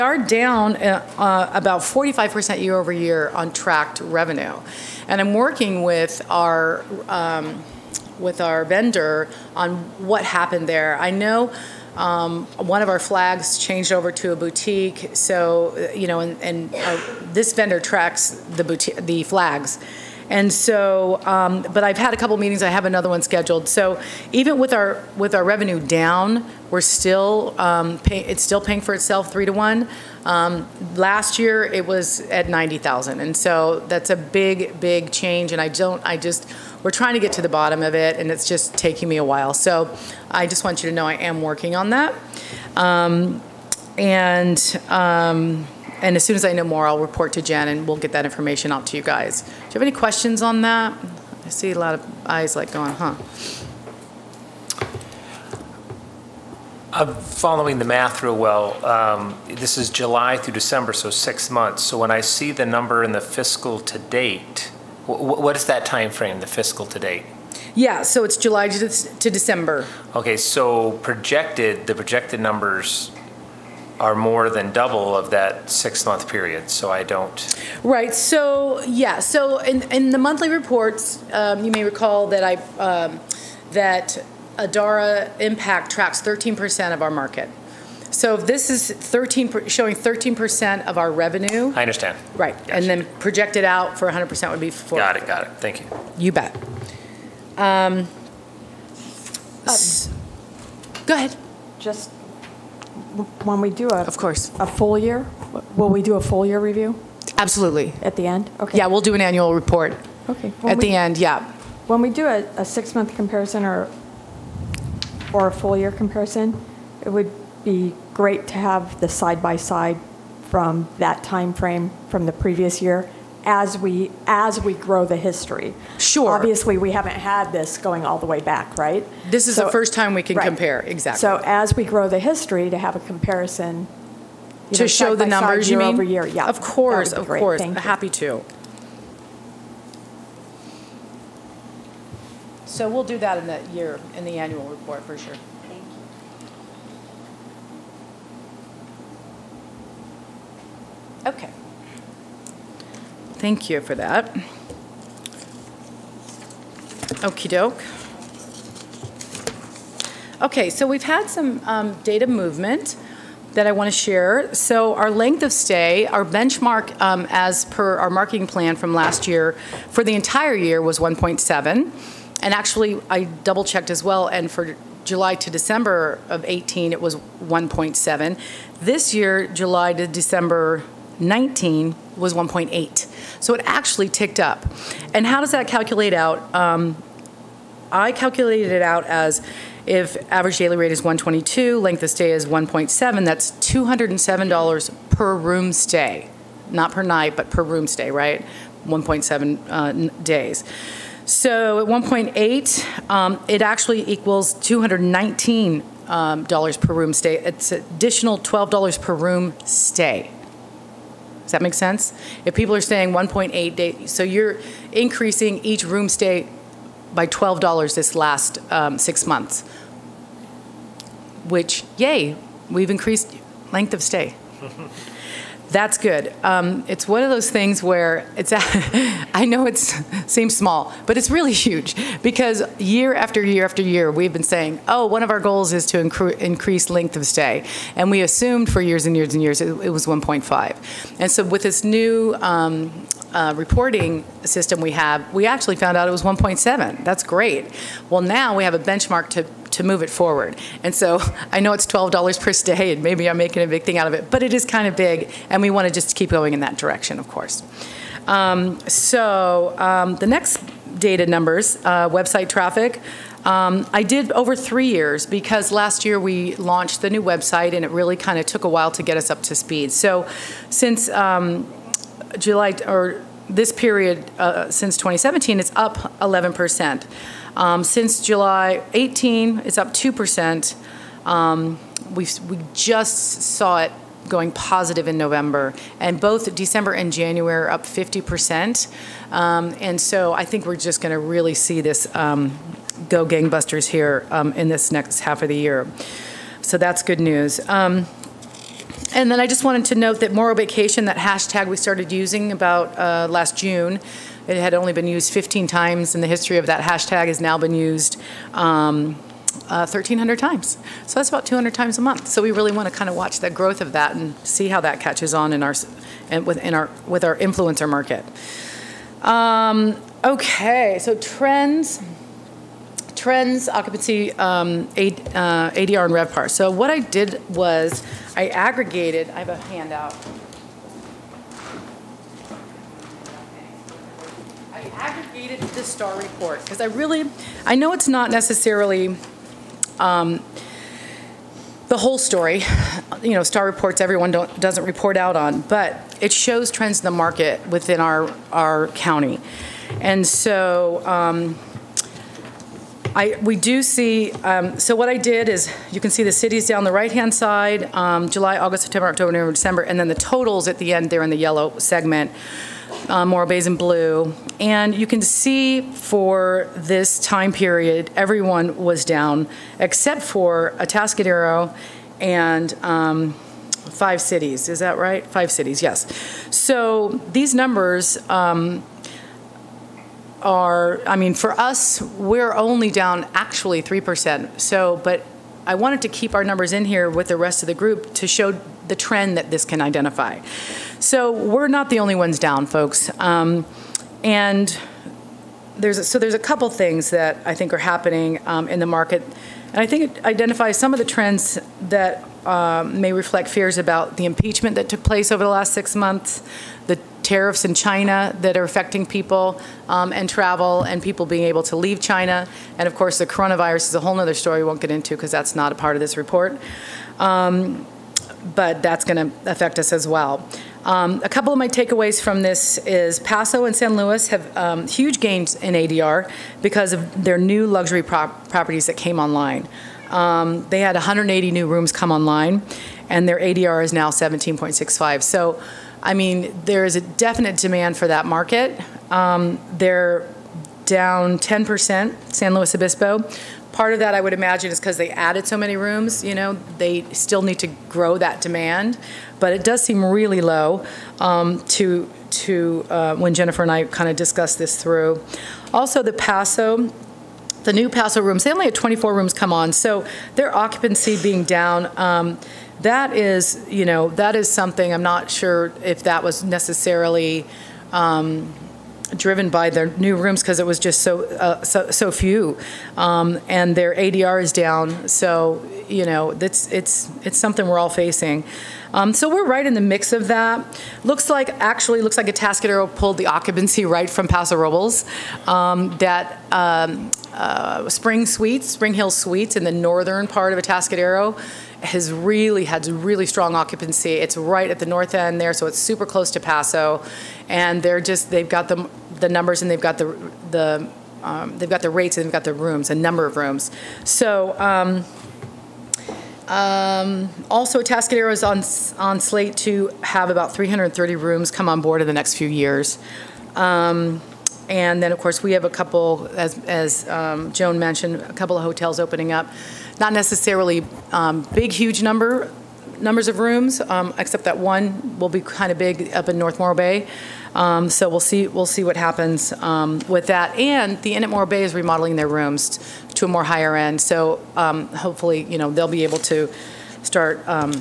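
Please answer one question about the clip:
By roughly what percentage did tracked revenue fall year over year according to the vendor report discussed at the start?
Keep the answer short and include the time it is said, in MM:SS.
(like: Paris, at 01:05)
45%, at 00:01.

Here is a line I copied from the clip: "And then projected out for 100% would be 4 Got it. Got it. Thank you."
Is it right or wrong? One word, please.
right.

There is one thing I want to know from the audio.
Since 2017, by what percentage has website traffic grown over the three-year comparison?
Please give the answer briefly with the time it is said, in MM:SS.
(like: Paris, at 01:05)
11%, at 04:36.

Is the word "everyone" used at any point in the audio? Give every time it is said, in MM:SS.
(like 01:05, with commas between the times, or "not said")
05:44, 06:08.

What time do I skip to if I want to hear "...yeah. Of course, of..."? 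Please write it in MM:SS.
02:16.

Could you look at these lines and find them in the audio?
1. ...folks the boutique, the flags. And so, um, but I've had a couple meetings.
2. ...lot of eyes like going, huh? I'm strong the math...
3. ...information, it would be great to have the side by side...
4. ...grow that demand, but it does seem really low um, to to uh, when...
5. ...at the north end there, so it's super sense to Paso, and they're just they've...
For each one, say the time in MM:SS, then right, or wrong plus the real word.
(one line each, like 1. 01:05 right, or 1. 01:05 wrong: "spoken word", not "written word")
1. 00:17 wrong: "tracks", not "folks"
2. 00:51 wrong: "following", not "strong"
3. 01:55 wrong: "comparison", not "information"
4. 07:27 right
5. 08:14 wrong: "close", not "sense".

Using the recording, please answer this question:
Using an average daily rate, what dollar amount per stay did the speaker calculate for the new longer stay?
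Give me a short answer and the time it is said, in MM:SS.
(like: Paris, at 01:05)
$219, at 03:24.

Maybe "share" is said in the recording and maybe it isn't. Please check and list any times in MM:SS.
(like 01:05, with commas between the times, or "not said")
02:43.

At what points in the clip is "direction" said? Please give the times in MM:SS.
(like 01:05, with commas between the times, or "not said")
04:16.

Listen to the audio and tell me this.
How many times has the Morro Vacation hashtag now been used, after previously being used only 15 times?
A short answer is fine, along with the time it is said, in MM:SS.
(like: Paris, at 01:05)
1,300, at 05:09.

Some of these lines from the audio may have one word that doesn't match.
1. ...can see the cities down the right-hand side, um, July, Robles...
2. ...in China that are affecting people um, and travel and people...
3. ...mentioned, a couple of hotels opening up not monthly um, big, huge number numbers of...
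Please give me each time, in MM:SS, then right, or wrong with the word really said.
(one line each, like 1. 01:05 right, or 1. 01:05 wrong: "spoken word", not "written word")
1. 05:56 wrong: "August", not "Robles"
2. 06:47 right
3. 08:37 wrong: "necessarily", not "monthly".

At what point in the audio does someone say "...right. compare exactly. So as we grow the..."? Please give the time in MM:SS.
02:10.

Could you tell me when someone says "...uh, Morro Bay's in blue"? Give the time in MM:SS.
06:03.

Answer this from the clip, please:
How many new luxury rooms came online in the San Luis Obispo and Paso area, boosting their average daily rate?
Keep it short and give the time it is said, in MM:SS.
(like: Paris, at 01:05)
180, at 07:10.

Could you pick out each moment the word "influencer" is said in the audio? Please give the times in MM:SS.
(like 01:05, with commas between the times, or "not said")
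05:17.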